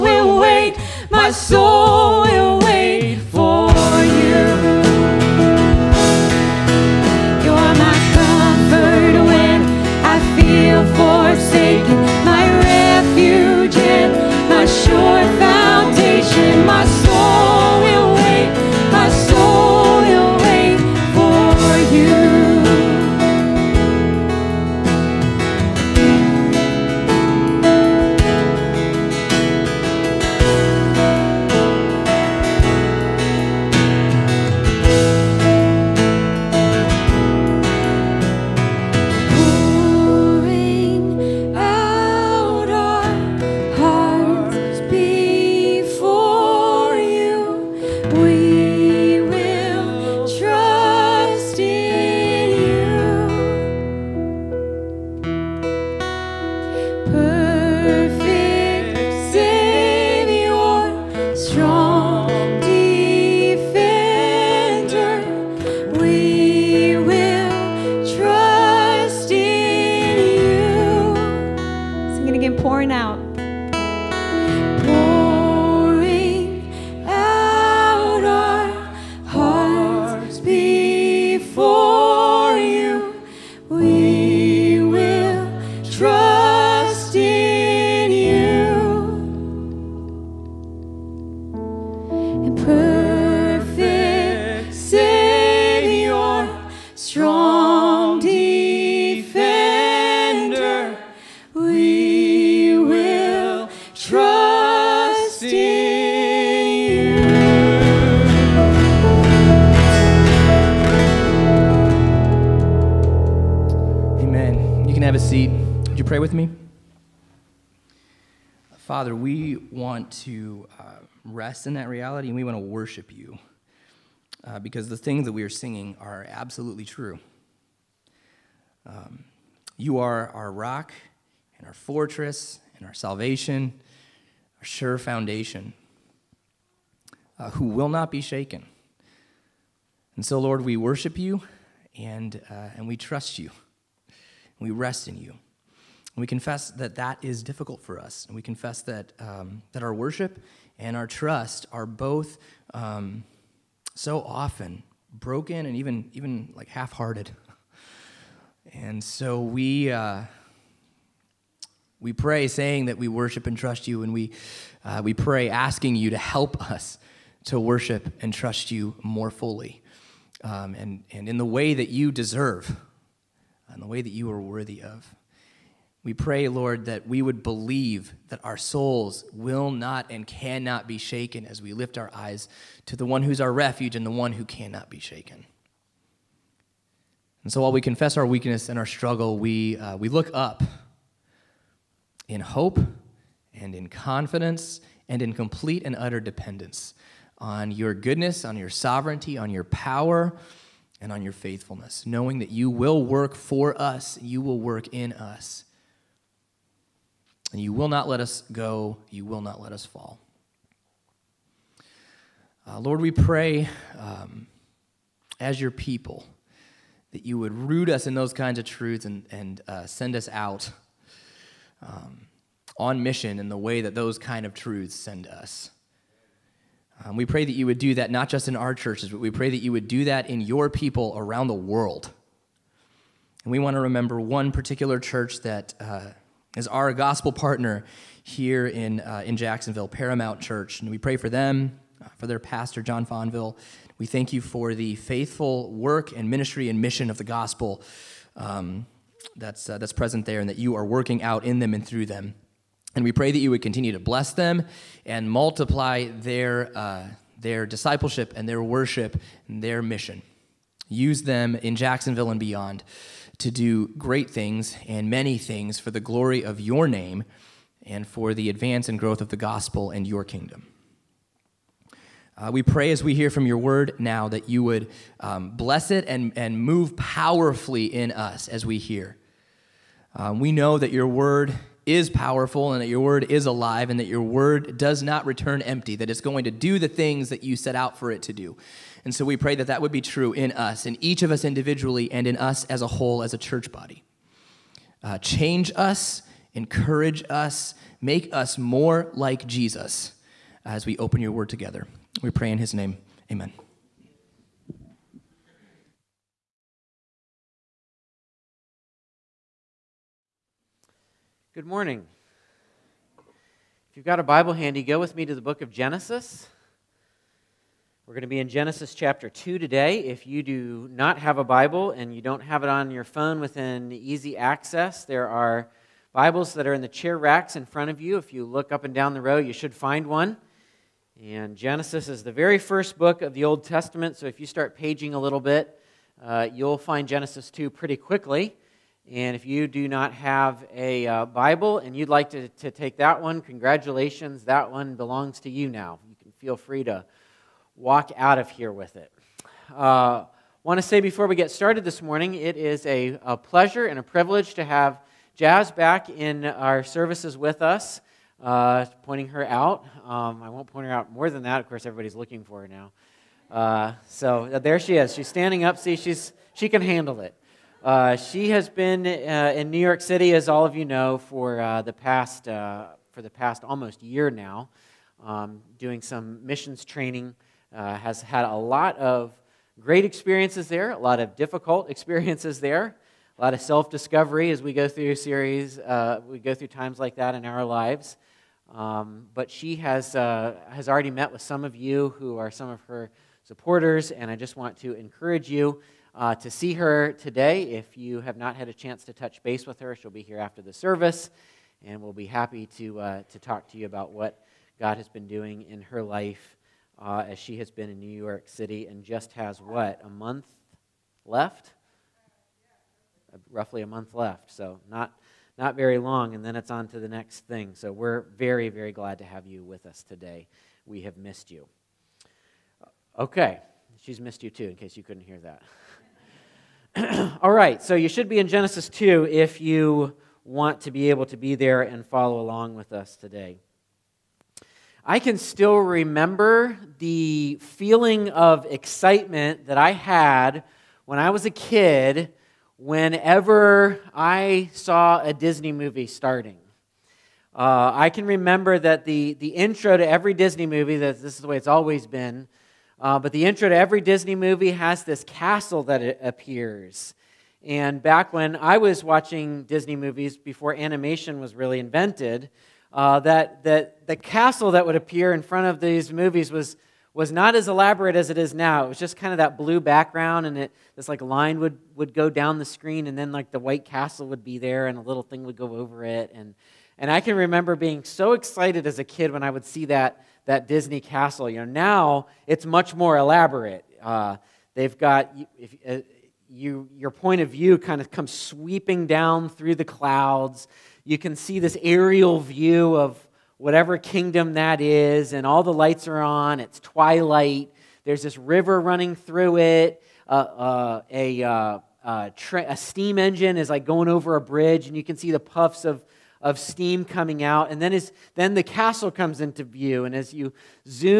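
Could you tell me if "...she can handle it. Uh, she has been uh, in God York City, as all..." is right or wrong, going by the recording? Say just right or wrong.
wrong.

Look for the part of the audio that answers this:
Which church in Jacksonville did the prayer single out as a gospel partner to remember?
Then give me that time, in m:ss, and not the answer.
3:59.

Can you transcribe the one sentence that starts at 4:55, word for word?
Uh, change us, encourage us, make us more like Jesus as we open your word together.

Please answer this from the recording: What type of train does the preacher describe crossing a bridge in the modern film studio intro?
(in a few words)
steam engine.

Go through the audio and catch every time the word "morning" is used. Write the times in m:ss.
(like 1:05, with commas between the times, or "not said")
5:11, 5:52.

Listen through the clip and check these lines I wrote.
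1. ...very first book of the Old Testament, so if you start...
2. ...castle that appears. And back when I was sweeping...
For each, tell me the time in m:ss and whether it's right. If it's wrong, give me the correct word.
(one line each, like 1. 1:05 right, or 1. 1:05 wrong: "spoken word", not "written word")
1. 5:32 right
2. 7:35 wrong: "watching", not "sweeping".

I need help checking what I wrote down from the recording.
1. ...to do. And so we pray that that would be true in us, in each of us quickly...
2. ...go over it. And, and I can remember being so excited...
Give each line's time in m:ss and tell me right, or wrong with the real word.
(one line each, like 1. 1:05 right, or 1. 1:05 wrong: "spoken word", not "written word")
1. 4:48 wrong: "individually", not "quickly"
2. 7:55 right.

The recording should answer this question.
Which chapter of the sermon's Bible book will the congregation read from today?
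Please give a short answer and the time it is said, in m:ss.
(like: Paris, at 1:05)
2, at 5:18.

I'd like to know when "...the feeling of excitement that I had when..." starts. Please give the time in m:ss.
7:16.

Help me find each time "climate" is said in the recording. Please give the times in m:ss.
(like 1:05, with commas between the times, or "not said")
not said.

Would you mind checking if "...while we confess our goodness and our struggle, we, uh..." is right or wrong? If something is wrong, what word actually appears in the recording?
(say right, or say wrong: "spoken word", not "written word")
wrong: "weakness", not "goodness".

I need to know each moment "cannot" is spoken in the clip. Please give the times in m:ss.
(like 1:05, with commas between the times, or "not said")
3:00, 3:04.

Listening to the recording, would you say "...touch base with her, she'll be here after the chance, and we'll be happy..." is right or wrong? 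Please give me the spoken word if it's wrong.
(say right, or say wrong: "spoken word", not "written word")
wrong: "service", not "chance".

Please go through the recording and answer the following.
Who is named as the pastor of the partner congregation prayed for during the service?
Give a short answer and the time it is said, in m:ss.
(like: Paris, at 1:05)
John Fonville, at 4:02.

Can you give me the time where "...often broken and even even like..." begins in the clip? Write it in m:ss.
2:34.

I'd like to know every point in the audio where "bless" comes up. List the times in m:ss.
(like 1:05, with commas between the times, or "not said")
4:13, 4:35.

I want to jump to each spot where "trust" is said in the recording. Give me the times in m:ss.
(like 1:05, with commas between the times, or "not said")
2:22, 2:31, 2:43, 2:48.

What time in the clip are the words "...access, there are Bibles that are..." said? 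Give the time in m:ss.
5:24.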